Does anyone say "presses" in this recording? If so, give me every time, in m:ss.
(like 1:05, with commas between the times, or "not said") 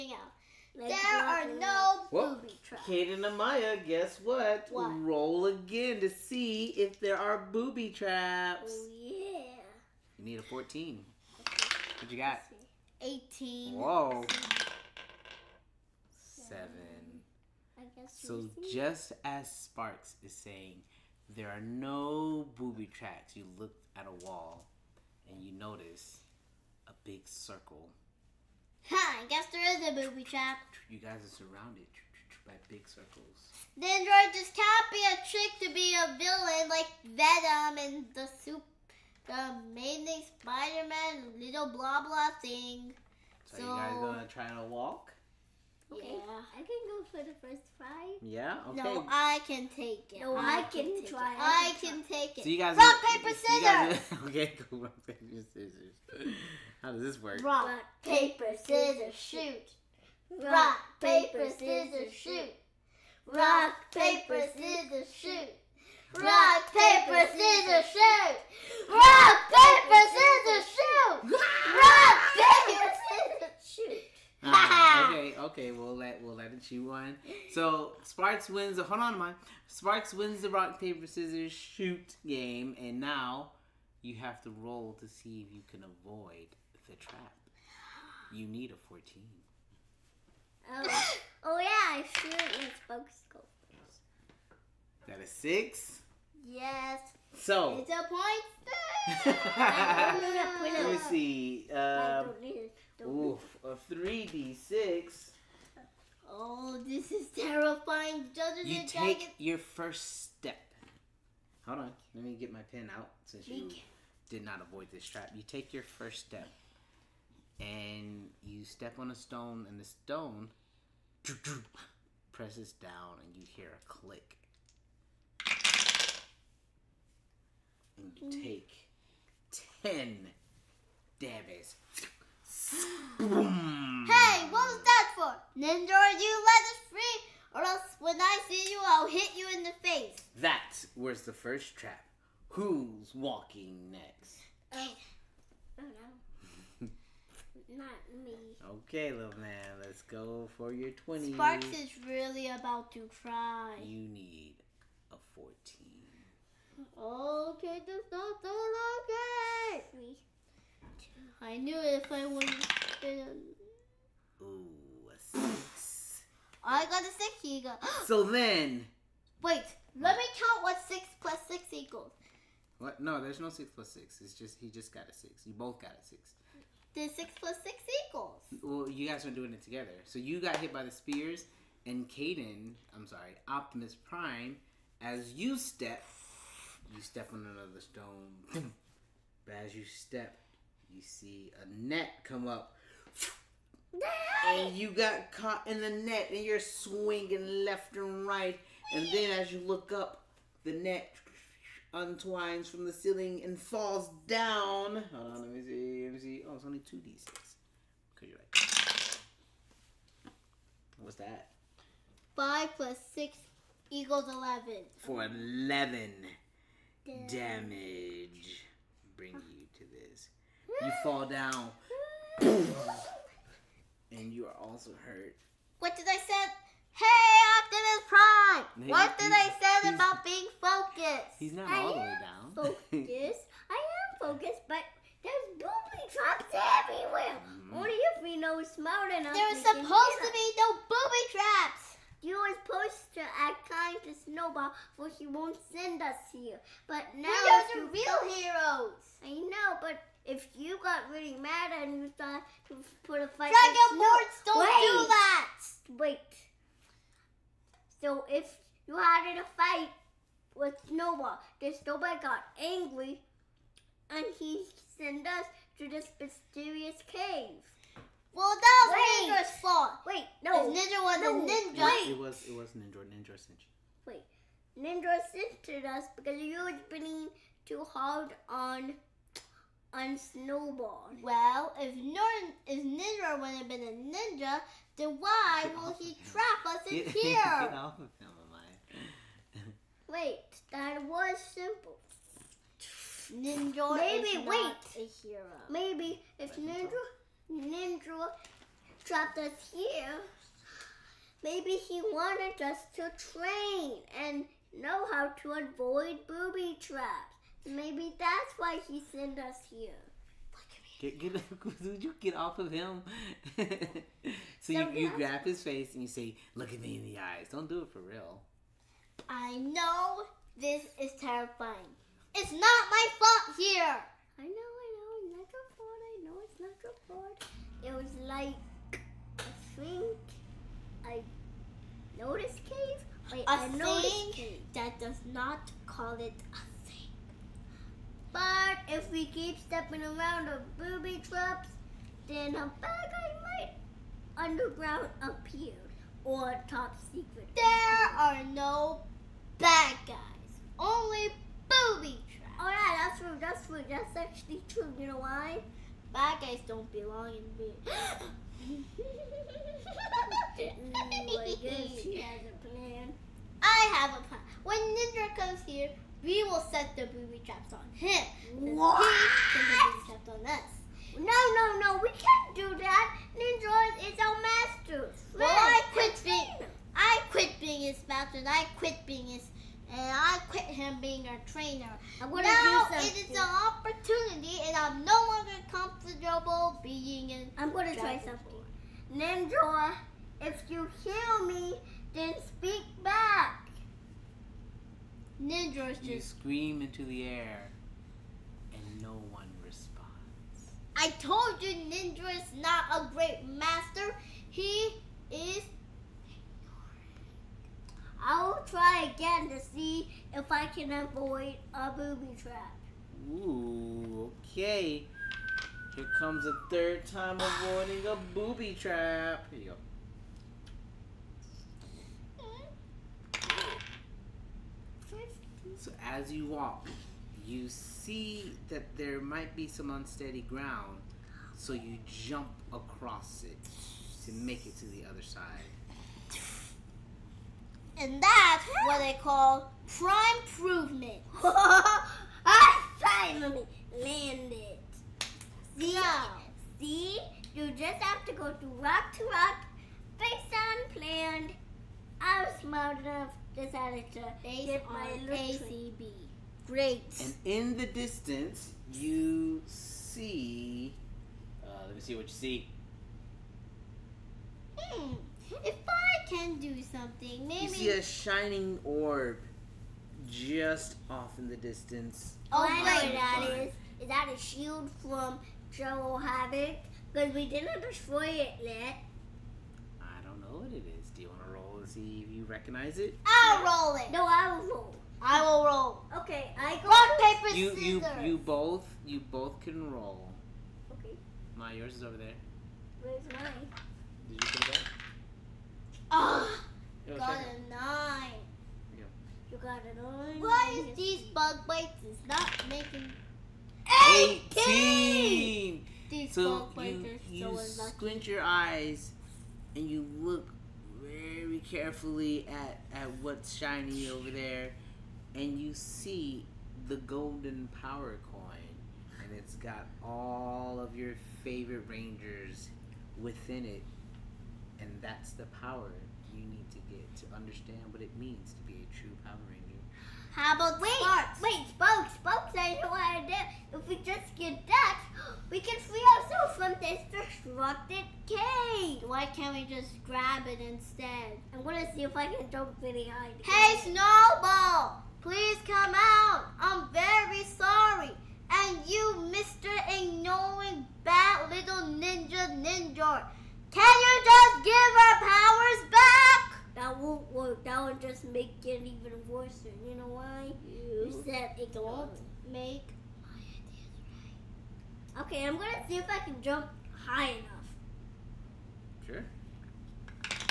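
2:02.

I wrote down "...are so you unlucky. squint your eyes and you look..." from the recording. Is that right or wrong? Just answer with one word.
right.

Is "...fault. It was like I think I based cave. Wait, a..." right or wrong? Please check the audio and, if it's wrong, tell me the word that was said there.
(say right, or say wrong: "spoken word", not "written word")
wrong: "noticed", not "based".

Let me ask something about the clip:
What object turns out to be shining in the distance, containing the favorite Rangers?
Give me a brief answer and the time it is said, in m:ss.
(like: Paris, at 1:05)
golden power coin, at 8:36.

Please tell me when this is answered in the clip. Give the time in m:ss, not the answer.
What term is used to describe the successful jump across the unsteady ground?
7:19.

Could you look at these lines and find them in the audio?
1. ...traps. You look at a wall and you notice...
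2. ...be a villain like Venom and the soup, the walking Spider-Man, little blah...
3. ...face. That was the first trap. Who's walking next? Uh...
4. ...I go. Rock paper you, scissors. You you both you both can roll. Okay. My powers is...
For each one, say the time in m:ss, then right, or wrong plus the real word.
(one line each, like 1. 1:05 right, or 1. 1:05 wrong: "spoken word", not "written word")
1. 0:22 right
2. 0:35 wrong: "amazing", not "walking"
3. 2:19 right
4. 8:06 wrong: "yours", not "powers".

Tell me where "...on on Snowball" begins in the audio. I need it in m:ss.
4:38.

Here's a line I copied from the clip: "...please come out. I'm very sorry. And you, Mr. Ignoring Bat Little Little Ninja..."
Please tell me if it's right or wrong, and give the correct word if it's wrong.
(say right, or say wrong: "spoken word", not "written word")
wrong: "Ninja", not "Little".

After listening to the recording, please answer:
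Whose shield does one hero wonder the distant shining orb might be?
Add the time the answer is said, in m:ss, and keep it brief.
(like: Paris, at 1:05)
Joe Havoc, at 7:55.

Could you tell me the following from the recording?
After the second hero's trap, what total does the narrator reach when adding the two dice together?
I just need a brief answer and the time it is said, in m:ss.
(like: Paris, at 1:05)
11, at 3:34.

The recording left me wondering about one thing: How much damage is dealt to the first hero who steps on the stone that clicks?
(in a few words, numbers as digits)
10.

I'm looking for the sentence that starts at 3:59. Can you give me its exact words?
There was supposed to be no booby traps.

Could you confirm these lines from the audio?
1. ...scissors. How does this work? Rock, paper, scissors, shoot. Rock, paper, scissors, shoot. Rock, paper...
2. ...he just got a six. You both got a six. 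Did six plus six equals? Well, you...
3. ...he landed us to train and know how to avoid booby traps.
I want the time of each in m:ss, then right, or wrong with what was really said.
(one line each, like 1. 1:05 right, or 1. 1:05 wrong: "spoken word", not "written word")
1. 0:55 right
2. 2:54 right
3. 5:01 wrong: "wanted", not "landed".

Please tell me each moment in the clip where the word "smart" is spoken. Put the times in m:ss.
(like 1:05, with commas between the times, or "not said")
3:58, 7:32.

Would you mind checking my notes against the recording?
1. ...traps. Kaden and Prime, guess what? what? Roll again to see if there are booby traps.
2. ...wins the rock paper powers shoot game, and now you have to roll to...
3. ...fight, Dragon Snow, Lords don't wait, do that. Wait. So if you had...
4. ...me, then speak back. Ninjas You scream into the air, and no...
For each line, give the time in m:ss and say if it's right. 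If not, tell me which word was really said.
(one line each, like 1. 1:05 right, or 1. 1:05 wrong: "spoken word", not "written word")
1. 0:02 wrong: "Amaya", not "Prime"
2. 1:20 wrong: "scissors", not "powers"
3. 4:13 right
4. 6:31 right.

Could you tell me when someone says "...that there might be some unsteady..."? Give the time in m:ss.
7:08.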